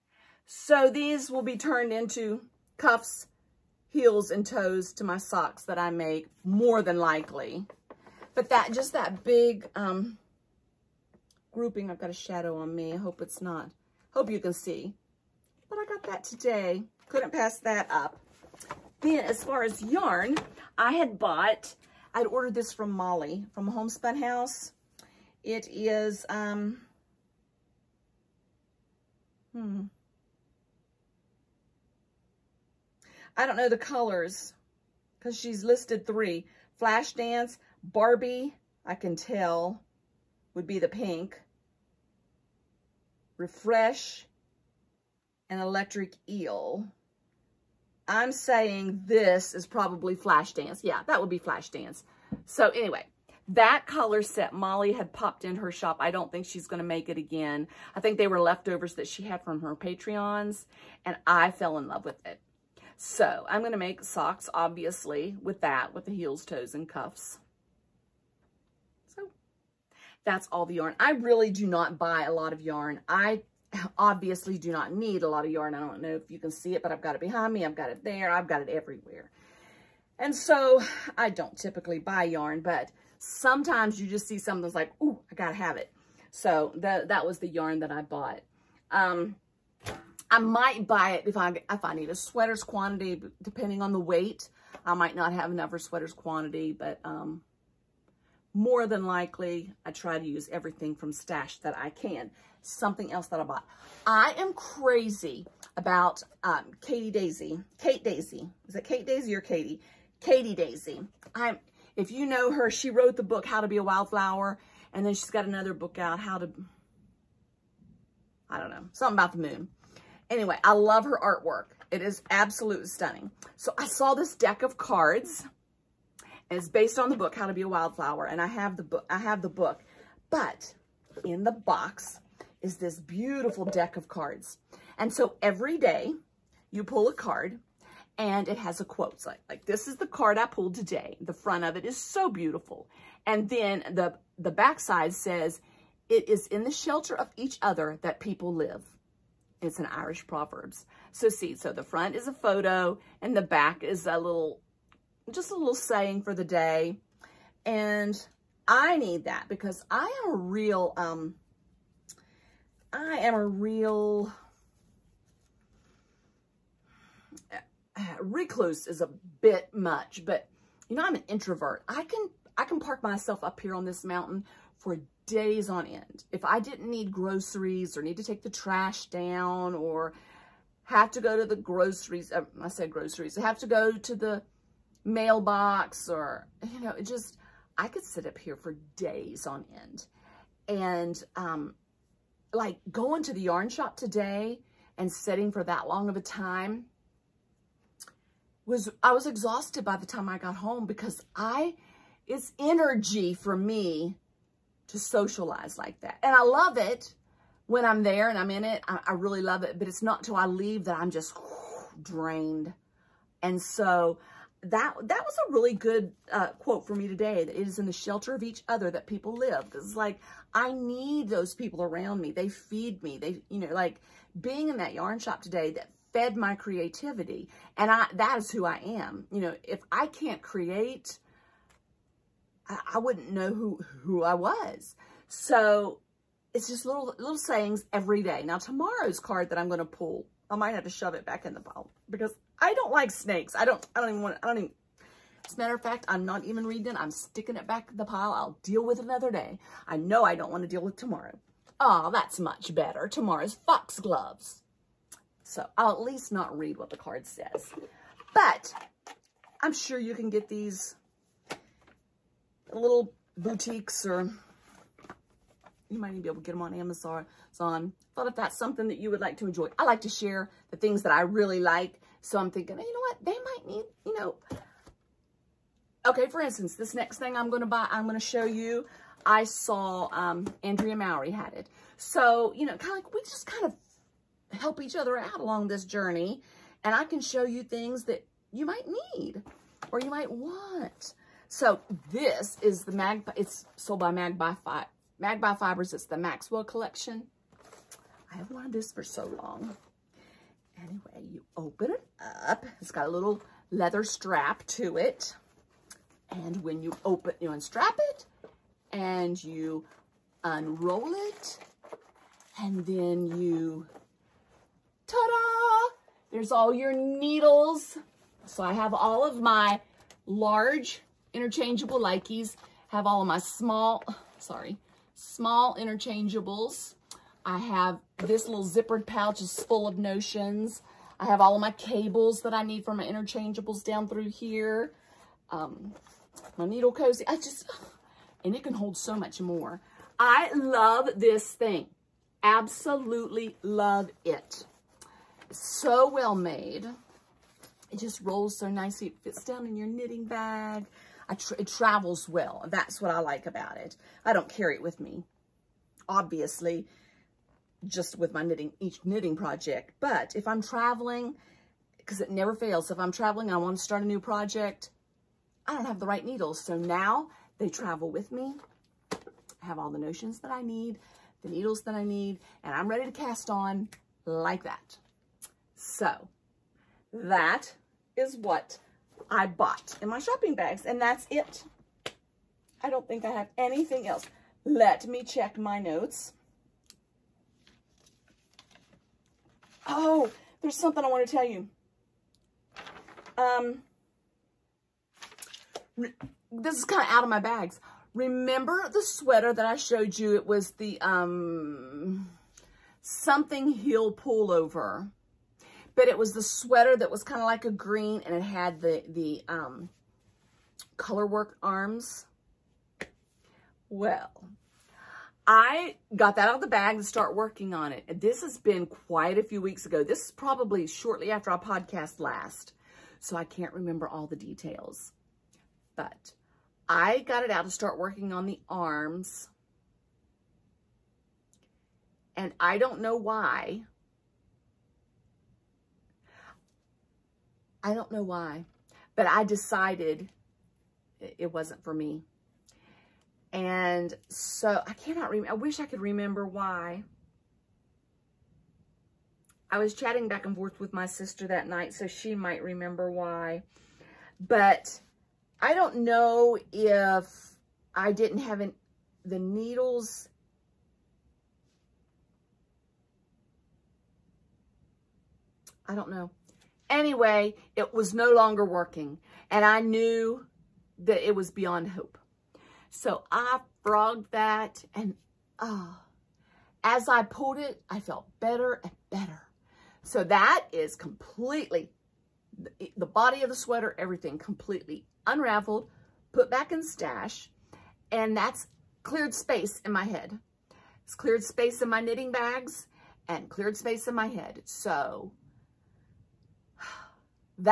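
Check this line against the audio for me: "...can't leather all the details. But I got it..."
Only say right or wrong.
wrong.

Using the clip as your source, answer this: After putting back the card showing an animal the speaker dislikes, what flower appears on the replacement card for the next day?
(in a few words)
Foxgloves.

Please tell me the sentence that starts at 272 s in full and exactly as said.
So I'm thinking, hey, you know what?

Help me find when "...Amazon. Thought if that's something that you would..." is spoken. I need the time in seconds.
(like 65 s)
266 s.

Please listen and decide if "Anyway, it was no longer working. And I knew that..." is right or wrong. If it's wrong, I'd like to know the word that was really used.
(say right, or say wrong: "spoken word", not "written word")
right.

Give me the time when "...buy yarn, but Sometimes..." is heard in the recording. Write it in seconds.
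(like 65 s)
81 s.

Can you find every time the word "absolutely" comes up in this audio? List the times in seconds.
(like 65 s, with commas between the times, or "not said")
122 s, 342 s.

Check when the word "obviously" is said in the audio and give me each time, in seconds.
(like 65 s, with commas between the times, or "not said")
64 s, 73 s, 356 s.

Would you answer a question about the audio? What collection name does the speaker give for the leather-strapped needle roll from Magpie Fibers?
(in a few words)
Maxwell Collection.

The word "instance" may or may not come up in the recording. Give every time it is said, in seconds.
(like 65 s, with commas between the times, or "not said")
276 s.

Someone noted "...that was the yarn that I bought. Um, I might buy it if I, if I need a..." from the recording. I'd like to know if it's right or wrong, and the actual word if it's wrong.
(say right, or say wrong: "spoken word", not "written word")
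right.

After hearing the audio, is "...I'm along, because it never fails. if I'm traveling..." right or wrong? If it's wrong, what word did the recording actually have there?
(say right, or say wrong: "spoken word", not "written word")
wrong: "traveling", not "along".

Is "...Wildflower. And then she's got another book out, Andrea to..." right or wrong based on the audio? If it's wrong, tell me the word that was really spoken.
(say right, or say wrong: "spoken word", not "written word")
wrong: "How", not "Andrea".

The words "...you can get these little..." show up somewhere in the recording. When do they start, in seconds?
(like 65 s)
259 s.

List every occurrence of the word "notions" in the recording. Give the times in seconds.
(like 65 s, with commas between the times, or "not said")
329 s, 369 s.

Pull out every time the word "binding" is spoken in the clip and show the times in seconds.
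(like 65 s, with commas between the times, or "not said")
not said.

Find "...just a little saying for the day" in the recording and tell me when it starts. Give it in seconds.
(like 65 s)
155 s.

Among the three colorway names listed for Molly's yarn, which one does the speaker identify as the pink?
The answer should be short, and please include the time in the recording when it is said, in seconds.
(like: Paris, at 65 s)
Barbie, at 37 s.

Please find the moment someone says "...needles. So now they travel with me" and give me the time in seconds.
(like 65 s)
366 s.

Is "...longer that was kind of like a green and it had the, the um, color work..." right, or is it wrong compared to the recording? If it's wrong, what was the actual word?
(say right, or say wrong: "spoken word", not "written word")
wrong: "sweater", not "longer".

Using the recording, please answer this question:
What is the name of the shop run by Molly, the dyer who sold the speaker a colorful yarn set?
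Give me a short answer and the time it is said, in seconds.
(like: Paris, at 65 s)
Homespun House, at 23 s.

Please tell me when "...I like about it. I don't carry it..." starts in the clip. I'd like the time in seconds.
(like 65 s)
353 s.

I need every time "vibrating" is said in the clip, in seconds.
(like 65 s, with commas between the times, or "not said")
not said.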